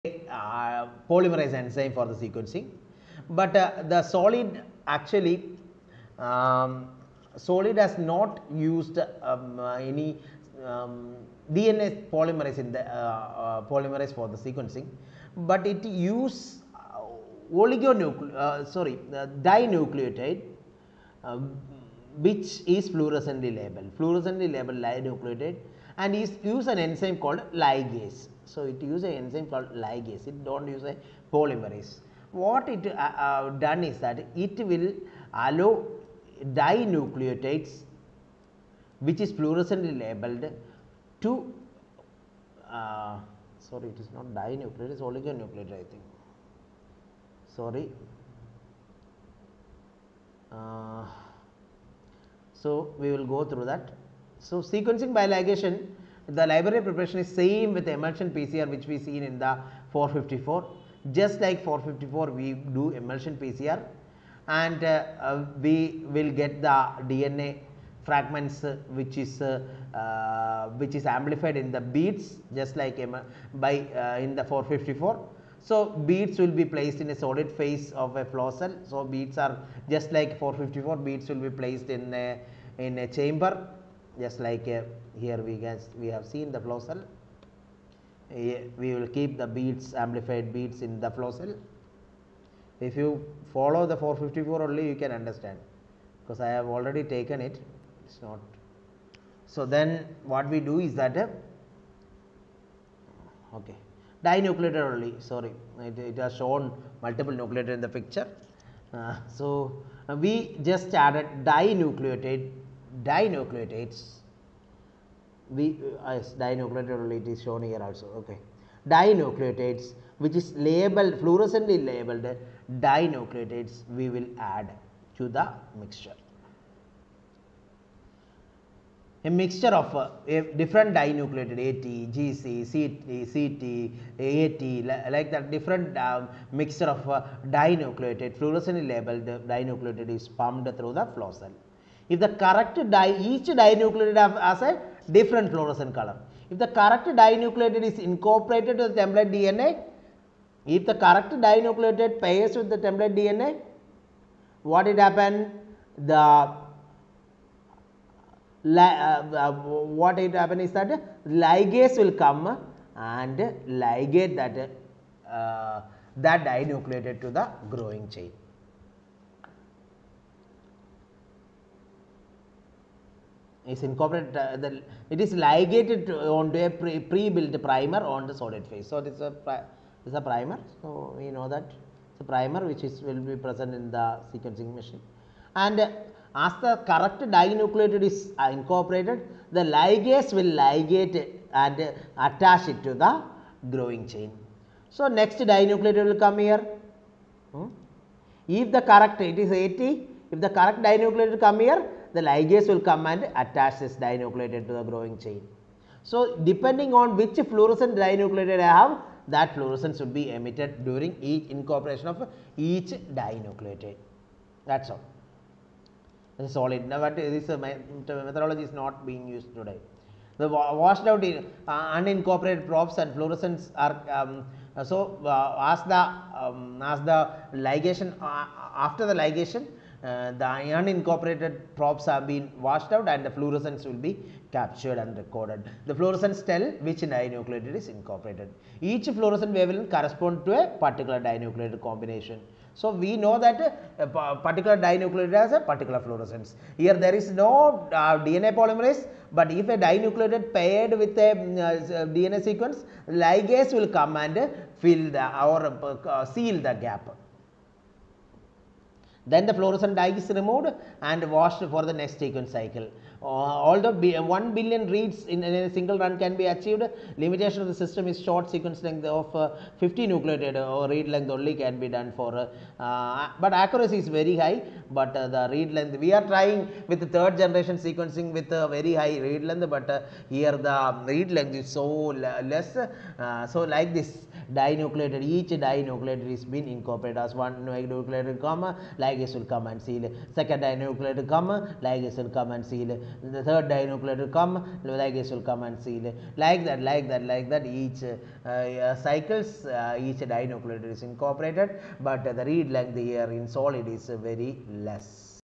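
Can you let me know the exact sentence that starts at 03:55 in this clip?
The fluorescence tell which dinucleotide is incorporated.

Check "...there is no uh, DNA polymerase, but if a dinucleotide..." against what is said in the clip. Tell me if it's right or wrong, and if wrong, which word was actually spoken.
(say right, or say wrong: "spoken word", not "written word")
right.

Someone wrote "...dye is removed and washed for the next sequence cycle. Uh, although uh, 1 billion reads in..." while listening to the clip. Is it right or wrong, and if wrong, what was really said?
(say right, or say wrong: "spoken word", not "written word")
right.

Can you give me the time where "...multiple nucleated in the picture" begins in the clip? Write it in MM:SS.
01:47.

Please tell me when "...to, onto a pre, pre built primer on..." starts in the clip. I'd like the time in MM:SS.
02:56.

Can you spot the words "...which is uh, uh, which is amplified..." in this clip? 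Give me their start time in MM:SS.
01:08.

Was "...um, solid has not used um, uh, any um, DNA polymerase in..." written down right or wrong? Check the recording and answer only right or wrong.
right.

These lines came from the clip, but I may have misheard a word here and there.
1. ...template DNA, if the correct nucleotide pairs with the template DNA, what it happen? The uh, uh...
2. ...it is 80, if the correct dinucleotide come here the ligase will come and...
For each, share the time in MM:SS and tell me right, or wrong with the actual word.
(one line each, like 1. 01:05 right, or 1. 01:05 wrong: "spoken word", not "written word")
1. 02:29 wrong: "dinucleotide", not "nucleotide"
2. 03:19 right.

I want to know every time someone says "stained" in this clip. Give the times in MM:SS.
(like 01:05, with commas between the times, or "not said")
not said.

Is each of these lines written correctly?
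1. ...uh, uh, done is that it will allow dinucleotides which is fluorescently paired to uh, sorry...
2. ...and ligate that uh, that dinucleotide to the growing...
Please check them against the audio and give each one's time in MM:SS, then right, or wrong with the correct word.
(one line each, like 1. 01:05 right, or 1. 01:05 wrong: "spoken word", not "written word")
1. 00:32 wrong: "labeled", not "paired"
2. 02:42 right.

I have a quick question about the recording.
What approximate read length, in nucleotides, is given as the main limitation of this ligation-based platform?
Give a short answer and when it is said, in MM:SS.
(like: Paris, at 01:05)
50 nucleotides, at 04:29.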